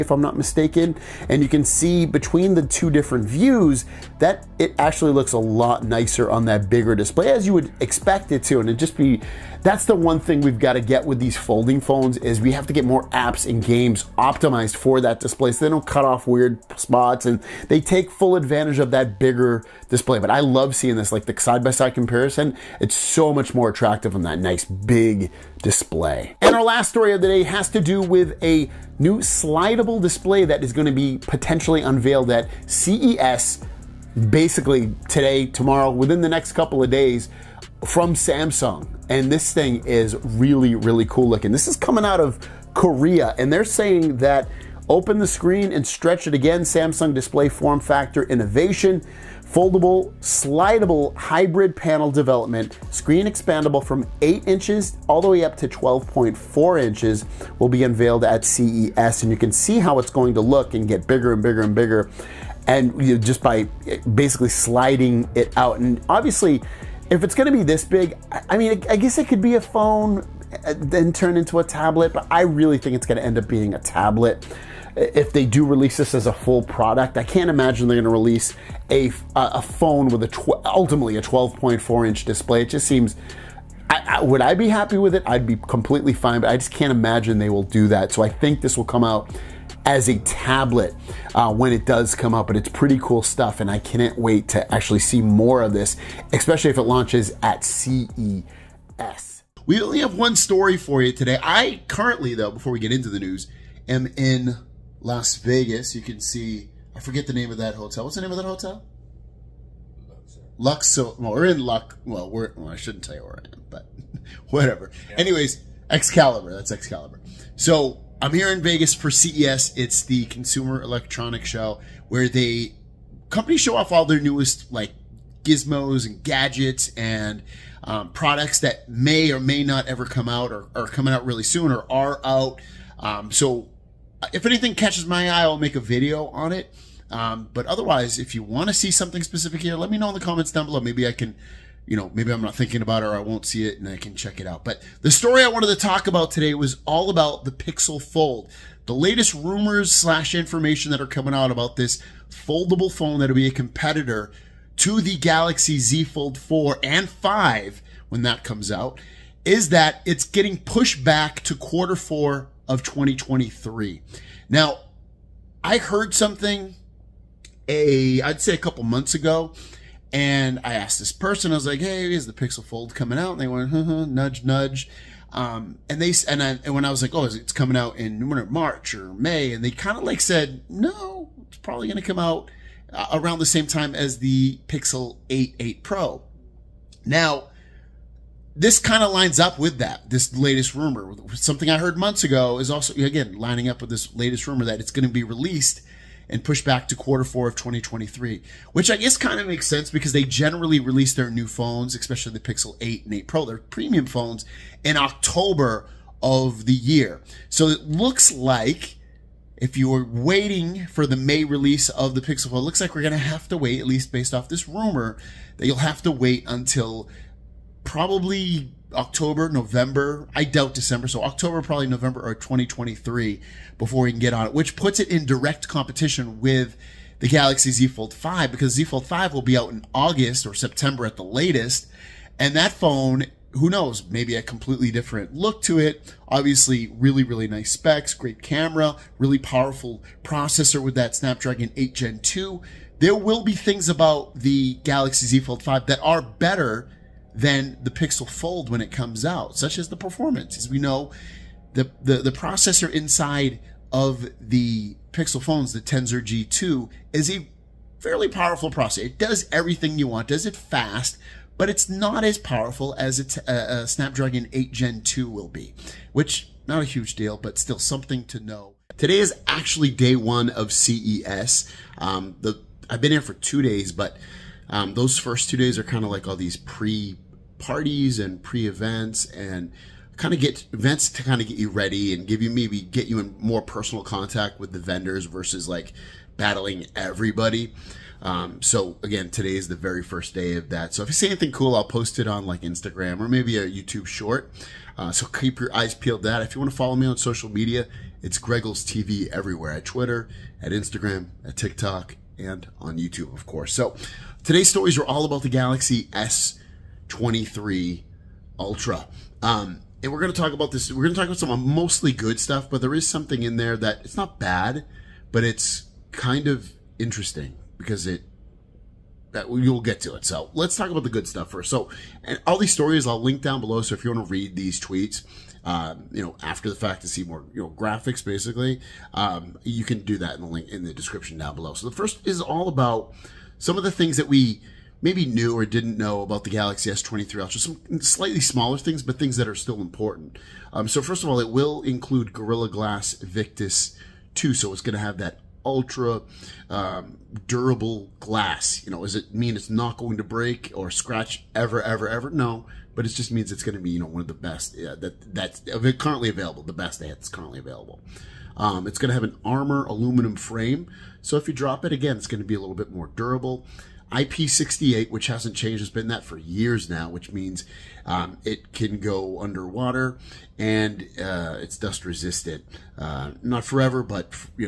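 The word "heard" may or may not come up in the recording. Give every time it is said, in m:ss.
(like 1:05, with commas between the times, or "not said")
2:45, 3:11.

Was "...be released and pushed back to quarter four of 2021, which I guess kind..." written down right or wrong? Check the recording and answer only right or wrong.
wrong.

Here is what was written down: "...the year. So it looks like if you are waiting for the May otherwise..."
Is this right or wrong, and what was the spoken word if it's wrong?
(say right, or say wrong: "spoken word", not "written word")
wrong: "release", not "otherwise".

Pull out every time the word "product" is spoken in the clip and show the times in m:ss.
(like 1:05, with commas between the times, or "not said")
1:16, 2:08.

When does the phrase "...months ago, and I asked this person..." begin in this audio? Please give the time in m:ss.
2:48.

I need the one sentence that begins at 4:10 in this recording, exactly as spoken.
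As we know, the, the, the processor inside of the Pixel phones, the Tensor G2, is a fairly powerful processor.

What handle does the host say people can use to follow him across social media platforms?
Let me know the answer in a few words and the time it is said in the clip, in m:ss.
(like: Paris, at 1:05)
Greggles TV, at 4:58.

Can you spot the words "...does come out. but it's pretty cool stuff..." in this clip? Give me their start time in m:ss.
1:31.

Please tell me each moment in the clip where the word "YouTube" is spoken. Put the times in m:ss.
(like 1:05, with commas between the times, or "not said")
4:53, 5:02.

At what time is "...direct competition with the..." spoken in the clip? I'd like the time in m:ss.
3:45.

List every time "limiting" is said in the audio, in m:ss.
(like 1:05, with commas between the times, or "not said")
not said.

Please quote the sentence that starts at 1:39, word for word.
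We only have one story for you today.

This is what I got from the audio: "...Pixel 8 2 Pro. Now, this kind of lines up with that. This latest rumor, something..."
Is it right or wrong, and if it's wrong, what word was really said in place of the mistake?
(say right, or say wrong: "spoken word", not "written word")
wrong: "8", not "2".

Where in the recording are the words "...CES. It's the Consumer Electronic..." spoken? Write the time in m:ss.
1:59.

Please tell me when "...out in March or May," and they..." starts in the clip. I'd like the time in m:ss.
2:57.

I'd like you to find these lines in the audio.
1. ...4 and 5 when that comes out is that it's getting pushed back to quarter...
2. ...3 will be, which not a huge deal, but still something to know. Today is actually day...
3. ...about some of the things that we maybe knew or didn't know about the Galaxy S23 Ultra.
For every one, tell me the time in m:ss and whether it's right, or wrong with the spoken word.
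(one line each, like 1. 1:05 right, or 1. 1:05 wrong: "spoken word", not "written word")
1. 2:36 right
2. 4:25 wrong: "2", not "3"
3. 5:32 right.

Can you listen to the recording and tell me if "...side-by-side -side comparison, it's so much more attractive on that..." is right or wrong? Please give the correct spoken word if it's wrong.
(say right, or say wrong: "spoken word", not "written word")
right.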